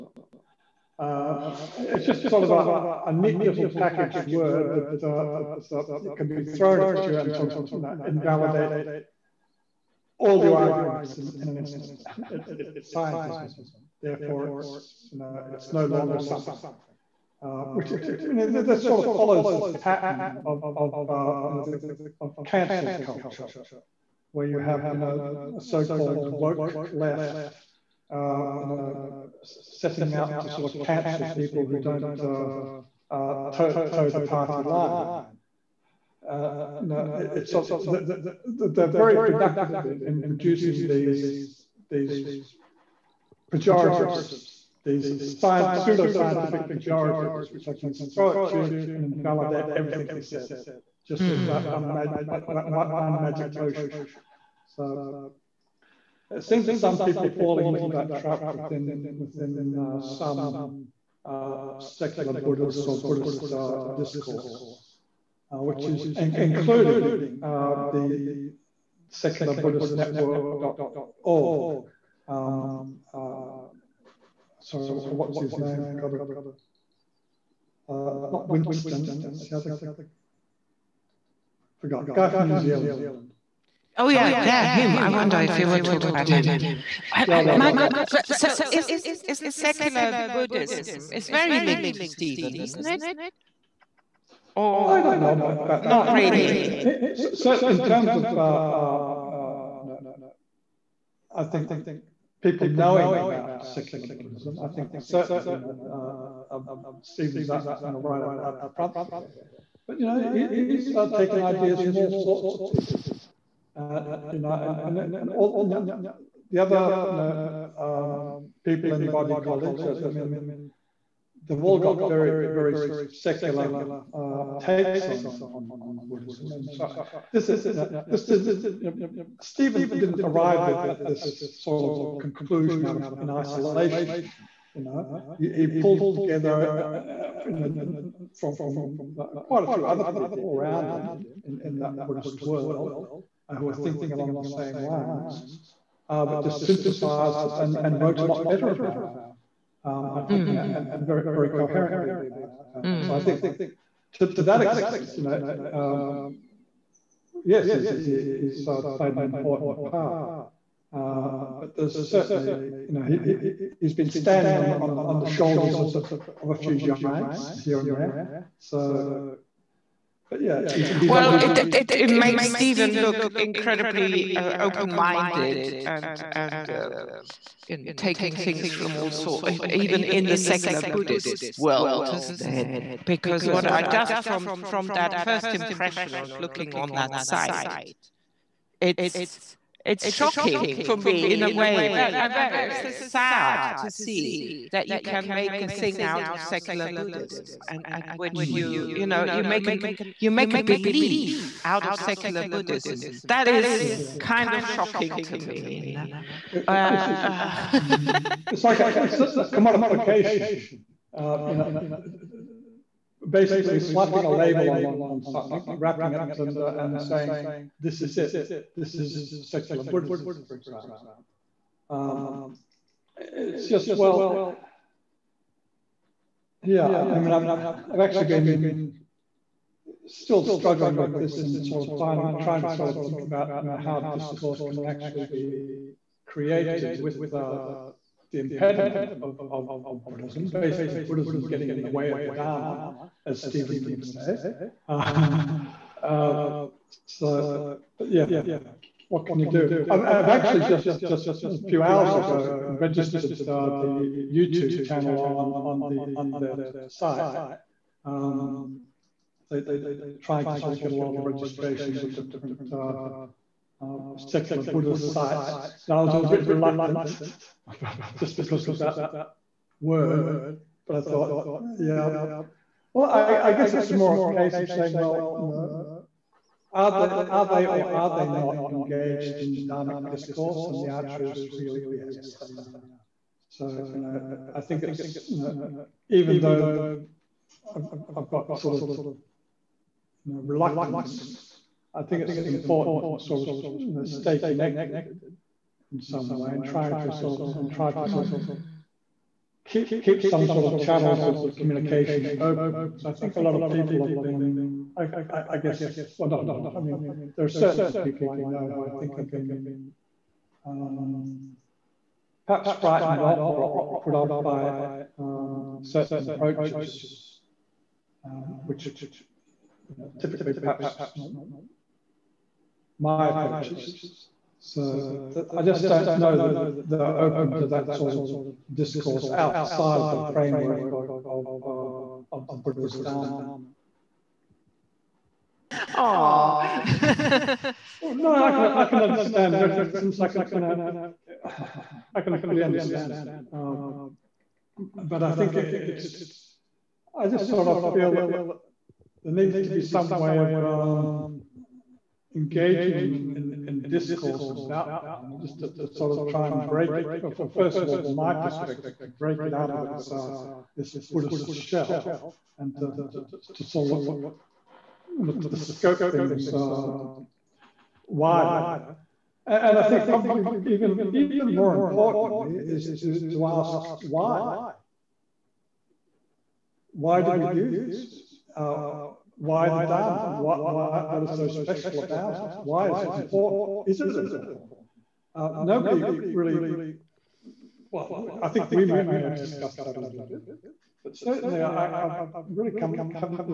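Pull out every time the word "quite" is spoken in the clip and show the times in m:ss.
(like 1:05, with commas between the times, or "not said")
2:19.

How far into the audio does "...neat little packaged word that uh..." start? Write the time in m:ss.
0:03.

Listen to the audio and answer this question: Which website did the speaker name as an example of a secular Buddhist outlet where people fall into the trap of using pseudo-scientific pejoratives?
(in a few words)
SecularBuddhistNetwork.org.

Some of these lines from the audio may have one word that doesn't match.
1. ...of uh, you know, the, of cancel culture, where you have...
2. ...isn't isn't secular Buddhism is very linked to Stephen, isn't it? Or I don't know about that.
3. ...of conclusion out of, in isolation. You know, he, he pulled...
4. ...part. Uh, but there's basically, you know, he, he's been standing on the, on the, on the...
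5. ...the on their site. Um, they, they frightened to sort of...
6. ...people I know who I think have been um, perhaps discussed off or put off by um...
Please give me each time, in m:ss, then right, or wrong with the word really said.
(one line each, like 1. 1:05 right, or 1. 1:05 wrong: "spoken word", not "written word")
1. 0:20 right
2. 1:28 right
3. 2:11 right
4. 2:39 wrong: "certainly", not "basically"
5. 4:15 wrong: "tried", not "frightened"
6. 5:07 wrong: "frightened", not "discussed".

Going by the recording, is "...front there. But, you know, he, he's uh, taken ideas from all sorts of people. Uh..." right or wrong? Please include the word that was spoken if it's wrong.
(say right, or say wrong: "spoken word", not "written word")
right.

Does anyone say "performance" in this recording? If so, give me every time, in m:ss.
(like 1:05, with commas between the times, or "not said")
not said.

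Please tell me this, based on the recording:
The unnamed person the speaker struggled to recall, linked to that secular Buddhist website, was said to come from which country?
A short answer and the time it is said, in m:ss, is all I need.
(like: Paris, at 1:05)
New Zealand, at 1:22.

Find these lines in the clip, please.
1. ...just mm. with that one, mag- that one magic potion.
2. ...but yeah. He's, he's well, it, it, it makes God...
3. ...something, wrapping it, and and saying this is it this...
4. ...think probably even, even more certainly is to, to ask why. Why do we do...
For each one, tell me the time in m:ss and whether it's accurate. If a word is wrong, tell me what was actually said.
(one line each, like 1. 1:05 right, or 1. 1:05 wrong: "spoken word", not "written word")
1. 0:51 right
2. 2:50 wrong: "Stephen", not "God"
3. 3:35 right
4. 6:09 wrong: "importantly", not "certainly".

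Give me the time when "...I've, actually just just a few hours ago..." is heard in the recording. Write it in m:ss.
4:10.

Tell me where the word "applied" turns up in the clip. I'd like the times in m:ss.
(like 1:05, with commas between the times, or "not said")
not said.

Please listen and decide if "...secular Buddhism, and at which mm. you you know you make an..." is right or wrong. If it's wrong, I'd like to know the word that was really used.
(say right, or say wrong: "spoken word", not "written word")
right.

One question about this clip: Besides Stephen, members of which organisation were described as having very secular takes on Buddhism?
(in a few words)
Bodhi College.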